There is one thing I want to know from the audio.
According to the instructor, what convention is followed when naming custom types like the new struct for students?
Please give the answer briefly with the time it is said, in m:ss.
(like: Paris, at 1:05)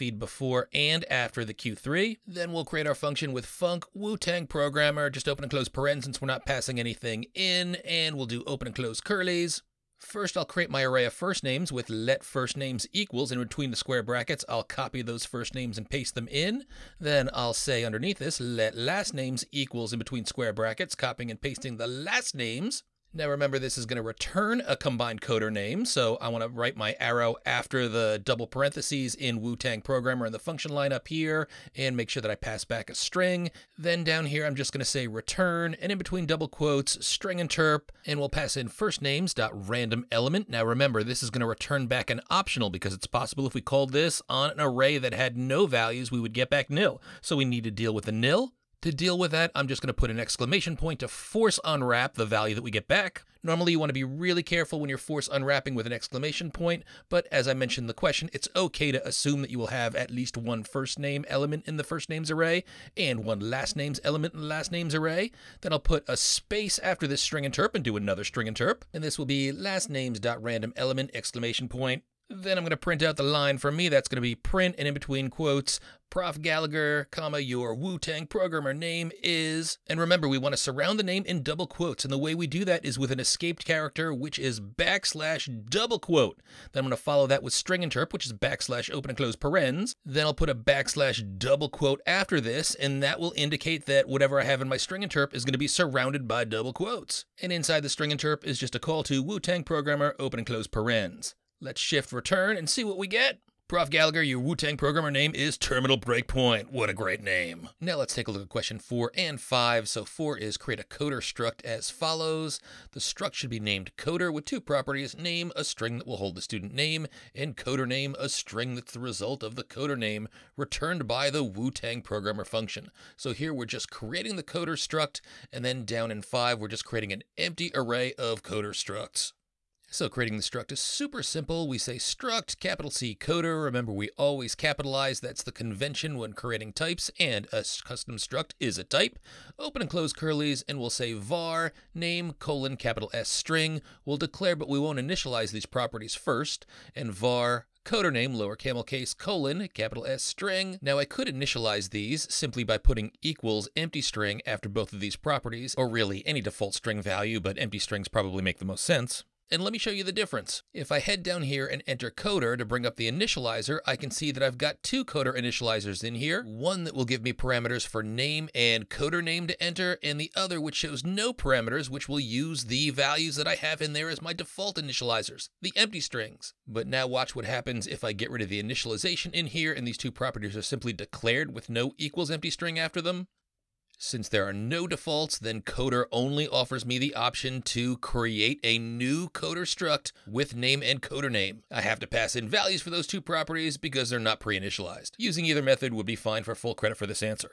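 we always capitalize, at 2:13.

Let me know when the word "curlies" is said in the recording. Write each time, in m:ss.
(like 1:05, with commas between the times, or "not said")
0:08, 2:20.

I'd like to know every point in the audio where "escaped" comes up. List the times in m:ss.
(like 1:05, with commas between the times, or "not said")
1:23.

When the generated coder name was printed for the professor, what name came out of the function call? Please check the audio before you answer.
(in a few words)
Terminal Breakpoint.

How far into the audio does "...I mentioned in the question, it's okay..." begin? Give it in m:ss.
0:57.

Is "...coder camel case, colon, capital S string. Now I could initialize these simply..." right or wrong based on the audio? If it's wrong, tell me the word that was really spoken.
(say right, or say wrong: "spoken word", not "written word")
wrong: "lower", not "coder".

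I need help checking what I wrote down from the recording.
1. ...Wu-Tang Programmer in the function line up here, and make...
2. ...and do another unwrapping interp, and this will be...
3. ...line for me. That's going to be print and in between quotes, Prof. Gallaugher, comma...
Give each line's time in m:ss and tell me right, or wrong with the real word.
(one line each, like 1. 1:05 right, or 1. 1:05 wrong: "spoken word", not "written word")
1. 0:29 right
2. 1:07 wrong: "string", not "unwrapping"
3. 1:13 right.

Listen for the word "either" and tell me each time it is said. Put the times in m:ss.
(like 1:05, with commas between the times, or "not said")
3:15.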